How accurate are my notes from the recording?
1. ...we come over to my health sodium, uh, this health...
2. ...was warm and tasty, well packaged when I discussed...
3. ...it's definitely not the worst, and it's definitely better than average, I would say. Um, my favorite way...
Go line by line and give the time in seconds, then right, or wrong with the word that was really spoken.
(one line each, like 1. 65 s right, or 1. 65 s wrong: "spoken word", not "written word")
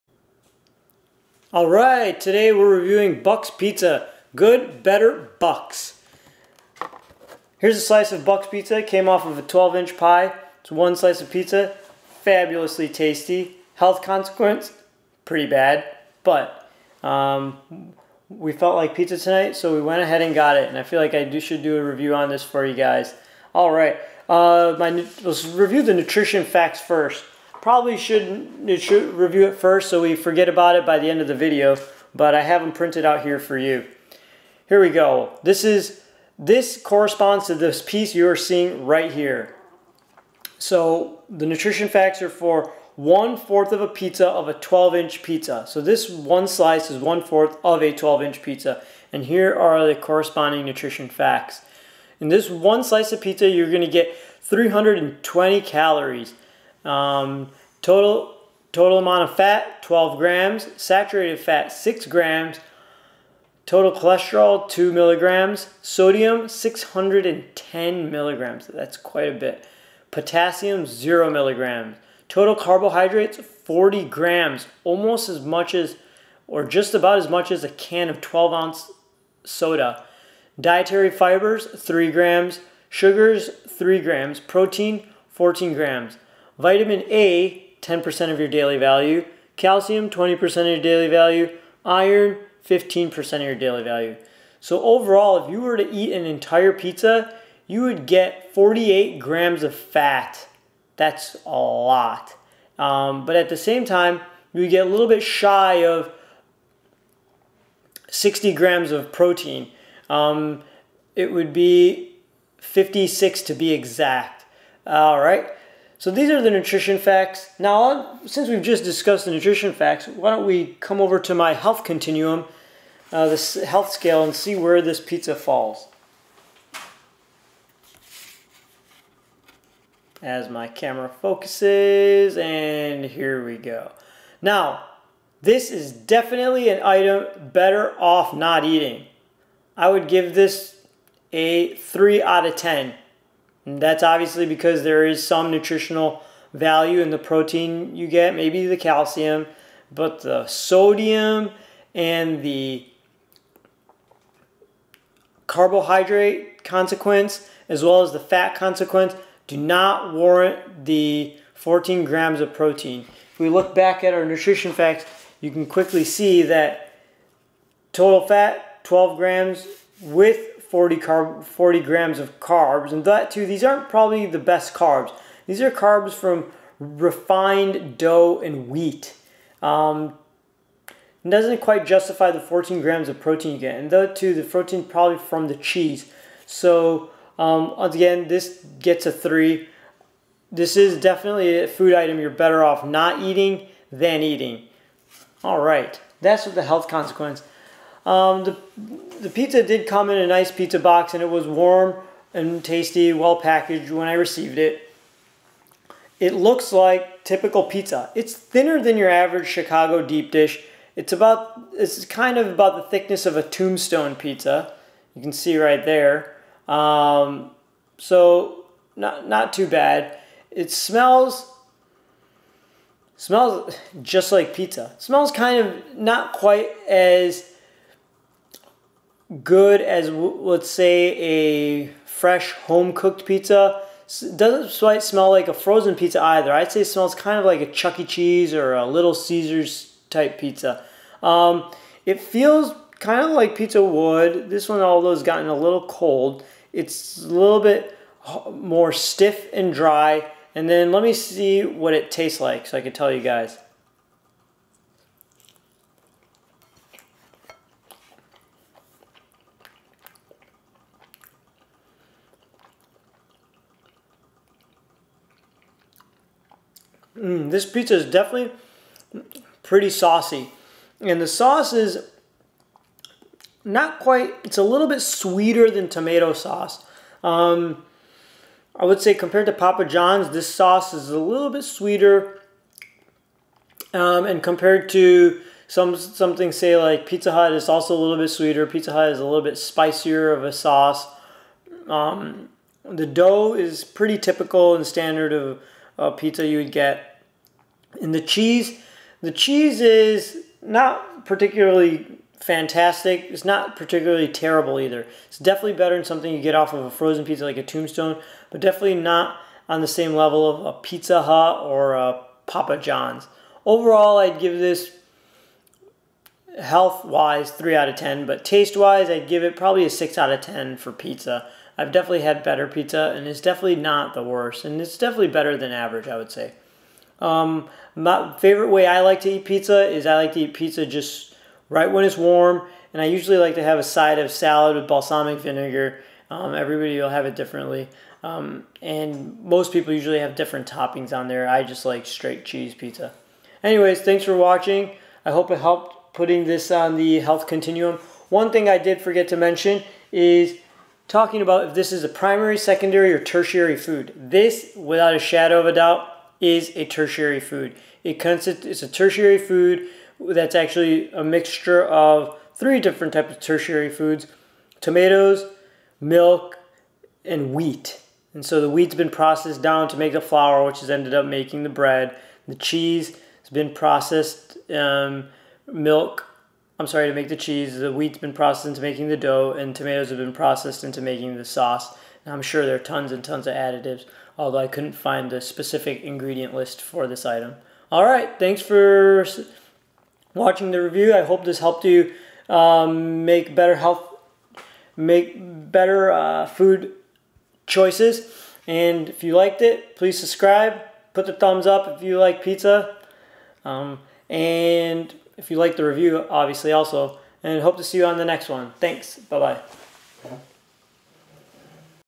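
1. 120 s wrong: "continuum", not "sodium"
2. 201 s wrong: "received", not "discussed"
3. 323 s right.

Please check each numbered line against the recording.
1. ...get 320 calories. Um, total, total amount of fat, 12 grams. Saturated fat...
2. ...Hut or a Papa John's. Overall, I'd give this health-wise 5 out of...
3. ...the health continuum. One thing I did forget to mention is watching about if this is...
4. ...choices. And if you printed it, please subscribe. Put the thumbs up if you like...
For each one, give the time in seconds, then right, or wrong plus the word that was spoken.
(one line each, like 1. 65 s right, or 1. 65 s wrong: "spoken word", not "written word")
1. 53 s right
2. 311 s wrong: "3", not "5"
3. 346 s wrong: "talking", not "watching"
4. 397 s wrong: "liked", not "printed".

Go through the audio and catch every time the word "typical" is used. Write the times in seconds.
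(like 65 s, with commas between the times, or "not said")
207 s, 294 s.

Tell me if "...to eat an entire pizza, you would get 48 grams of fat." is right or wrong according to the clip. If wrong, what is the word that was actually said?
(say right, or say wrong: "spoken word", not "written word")
right.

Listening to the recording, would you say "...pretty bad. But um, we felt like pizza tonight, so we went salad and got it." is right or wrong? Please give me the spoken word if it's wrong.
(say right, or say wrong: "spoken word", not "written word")
wrong: "ahead", not "salad".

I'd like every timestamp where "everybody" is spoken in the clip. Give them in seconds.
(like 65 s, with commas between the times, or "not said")
336 s.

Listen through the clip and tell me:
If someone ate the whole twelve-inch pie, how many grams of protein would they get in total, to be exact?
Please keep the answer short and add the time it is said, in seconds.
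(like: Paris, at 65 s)
56, at 112 s.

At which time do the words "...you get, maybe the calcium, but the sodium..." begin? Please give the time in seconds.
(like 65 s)
147 s.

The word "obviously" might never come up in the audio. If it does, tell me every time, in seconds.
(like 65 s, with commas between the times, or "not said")
144 s, 406 s.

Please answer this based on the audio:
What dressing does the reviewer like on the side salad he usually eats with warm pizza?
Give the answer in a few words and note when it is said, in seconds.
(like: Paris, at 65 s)
balsamic vinegar, at 334 s.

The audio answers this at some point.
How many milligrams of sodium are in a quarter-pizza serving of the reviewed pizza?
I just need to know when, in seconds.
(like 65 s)
66 s.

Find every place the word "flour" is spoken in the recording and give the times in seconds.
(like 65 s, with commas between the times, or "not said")
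370 s.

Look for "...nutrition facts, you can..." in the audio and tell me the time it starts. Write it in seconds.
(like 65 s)
164 s.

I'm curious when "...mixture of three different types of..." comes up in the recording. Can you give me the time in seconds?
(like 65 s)
361 s.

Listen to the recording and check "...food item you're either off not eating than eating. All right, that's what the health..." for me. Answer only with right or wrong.
wrong.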